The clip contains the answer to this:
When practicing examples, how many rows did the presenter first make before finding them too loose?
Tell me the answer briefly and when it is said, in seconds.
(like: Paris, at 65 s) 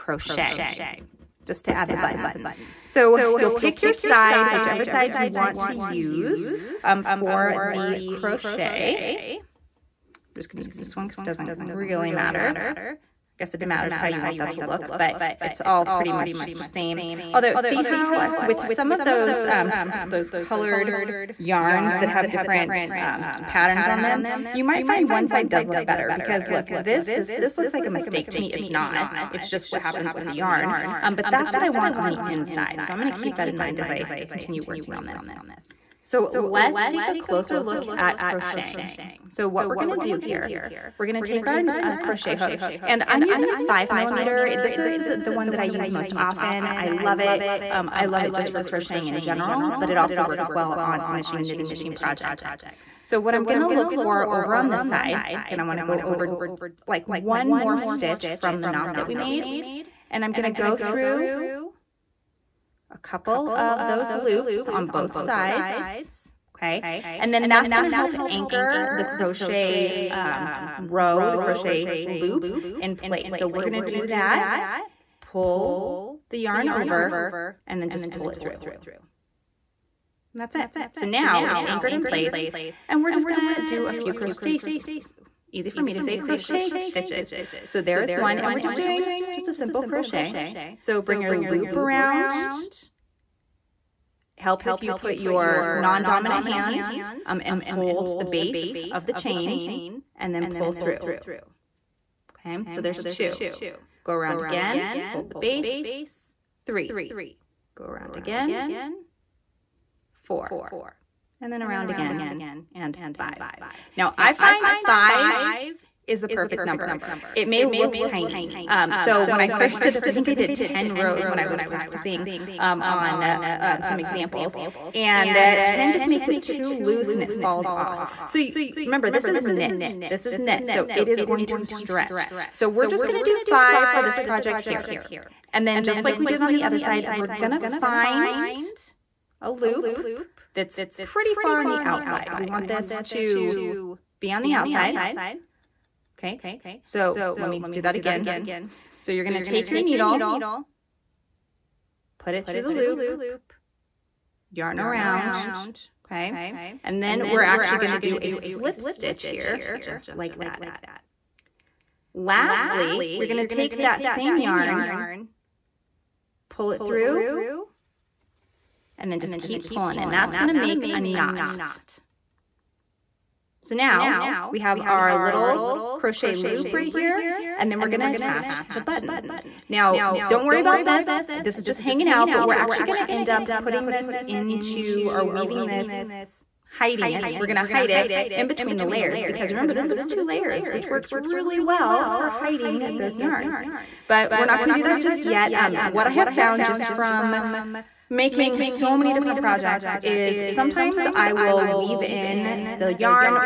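10, at 120 s.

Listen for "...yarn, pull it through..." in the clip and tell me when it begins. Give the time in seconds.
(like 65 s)
164 s.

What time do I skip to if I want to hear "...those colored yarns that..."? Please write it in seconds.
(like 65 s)
20 s.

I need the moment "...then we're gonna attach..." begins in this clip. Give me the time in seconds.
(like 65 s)
177 s.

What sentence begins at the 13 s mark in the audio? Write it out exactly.
I guess it matters how you want that to look, but it's all pretty much the same.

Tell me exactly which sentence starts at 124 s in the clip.
And uh, 10 just makes it too loose and it falls off.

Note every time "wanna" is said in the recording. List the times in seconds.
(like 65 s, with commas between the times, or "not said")
55 s.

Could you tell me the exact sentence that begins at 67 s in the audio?
And then that's gonna help anchor the crochet um, row, the crochet loop in place.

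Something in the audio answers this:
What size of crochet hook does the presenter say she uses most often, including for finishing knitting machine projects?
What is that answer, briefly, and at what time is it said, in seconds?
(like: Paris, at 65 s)
5 millimeter, at 43 s.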